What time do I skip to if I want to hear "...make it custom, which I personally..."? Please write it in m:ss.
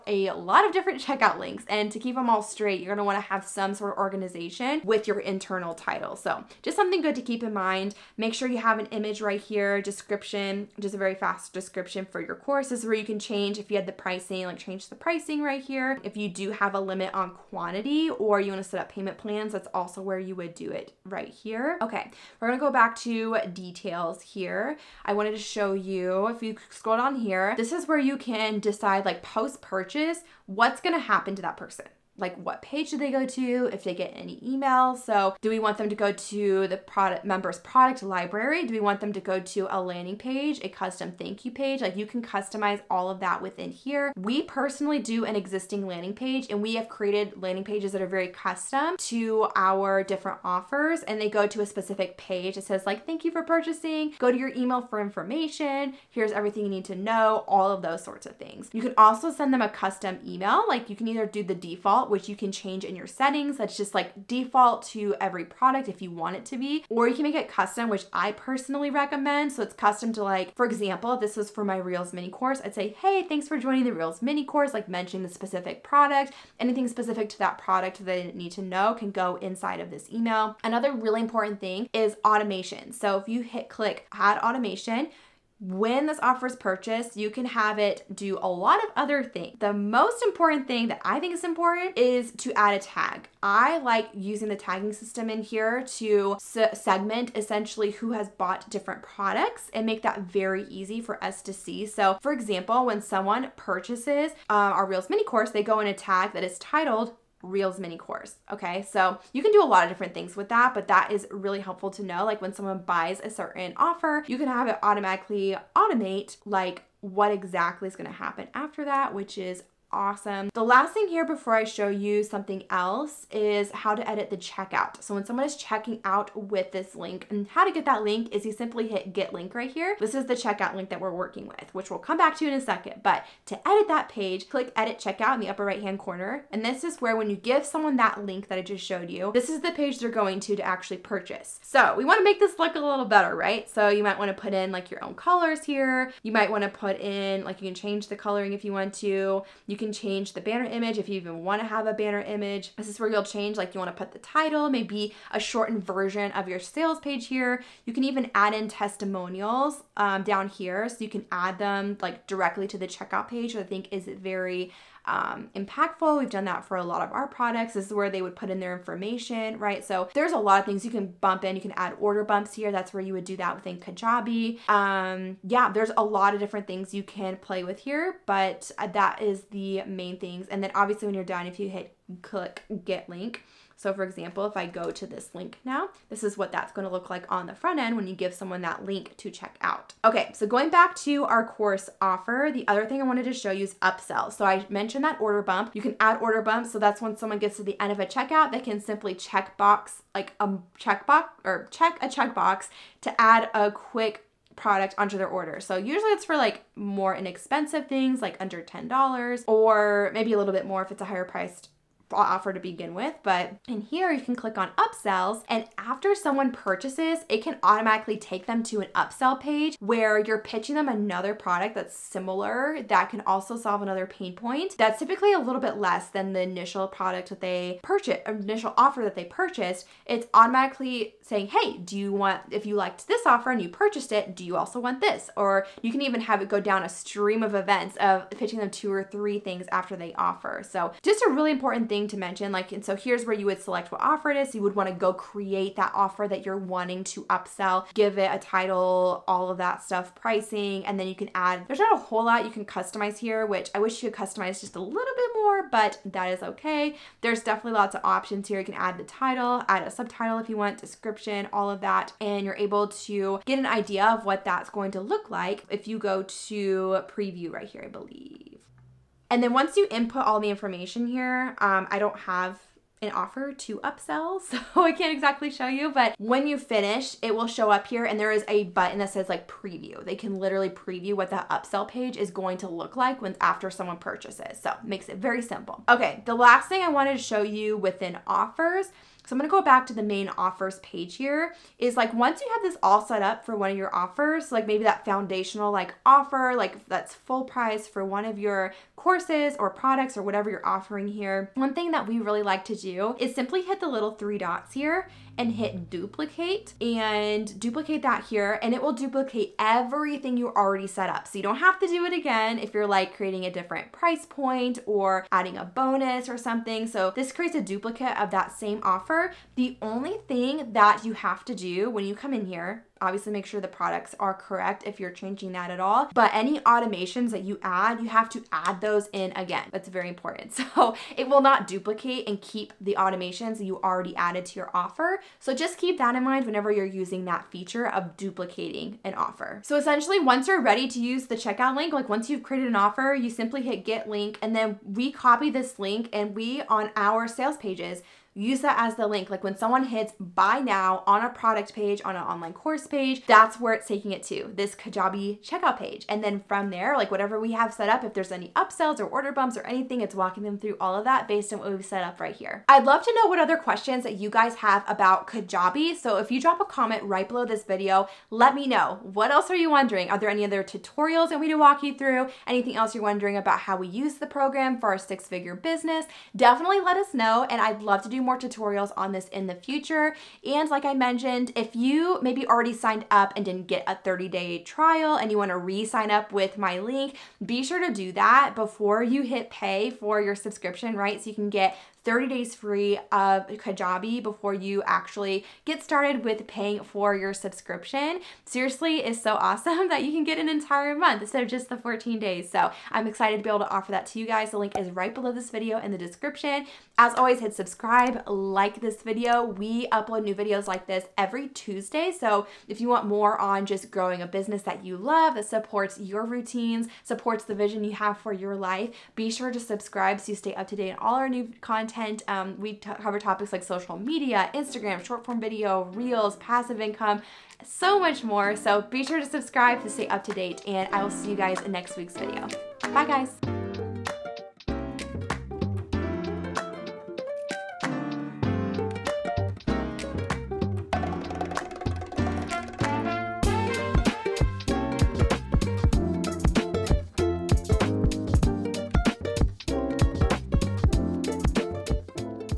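1:07.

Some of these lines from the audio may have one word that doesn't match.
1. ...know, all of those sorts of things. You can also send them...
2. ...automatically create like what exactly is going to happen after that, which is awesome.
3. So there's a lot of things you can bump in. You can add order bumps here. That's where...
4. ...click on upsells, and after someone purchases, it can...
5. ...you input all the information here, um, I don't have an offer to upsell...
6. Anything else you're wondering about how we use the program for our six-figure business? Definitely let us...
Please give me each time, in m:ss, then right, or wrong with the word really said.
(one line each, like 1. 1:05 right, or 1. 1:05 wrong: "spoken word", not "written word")
1. 0:56 right
2. 1:54 wrong: "automate", not "create"
3. 2:49 right
4. 3:34 right
5. 4:29 right
6. 6:12 right.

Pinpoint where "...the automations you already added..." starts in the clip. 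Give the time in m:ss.
5:32.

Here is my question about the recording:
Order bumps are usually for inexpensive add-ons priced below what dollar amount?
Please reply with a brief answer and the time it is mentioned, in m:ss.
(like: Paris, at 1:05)
$10, at 3:28.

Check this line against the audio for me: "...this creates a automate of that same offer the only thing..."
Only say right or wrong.
wrong.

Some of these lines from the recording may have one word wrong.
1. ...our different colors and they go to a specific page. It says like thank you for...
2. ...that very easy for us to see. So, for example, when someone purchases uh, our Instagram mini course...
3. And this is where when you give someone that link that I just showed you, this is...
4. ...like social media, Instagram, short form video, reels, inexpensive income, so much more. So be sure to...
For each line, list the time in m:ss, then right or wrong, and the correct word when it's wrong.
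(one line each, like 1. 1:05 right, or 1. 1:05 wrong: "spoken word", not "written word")
1. 0:49 wrong: "offers", not "colors"
2. 1:40 wrong: "Reels", not "Instagram"
3. 2:16 right
4. 7:03 wrong: "passive", not "inexpensive".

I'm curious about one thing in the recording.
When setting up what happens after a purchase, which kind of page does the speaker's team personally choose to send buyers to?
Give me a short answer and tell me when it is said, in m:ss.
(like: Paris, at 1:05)
existing landing page, at 0:45.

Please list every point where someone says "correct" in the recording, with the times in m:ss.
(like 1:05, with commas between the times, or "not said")
5:24.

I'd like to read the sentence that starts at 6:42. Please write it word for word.
So I'm excited to be able to offer that to you guys.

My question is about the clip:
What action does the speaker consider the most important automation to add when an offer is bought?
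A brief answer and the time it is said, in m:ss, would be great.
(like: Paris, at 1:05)
add a tag, at 1:32.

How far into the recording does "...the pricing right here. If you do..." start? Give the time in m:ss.
0:14.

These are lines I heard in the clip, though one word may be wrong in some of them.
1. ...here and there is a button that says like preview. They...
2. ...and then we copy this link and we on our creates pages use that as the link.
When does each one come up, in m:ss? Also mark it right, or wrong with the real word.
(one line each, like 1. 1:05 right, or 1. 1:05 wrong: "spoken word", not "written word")
1. 4:37 right
2. 5:44 wrong: "sales", not "creates".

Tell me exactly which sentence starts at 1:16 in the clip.
Anything specific to that product that they need to know can go inside of this email.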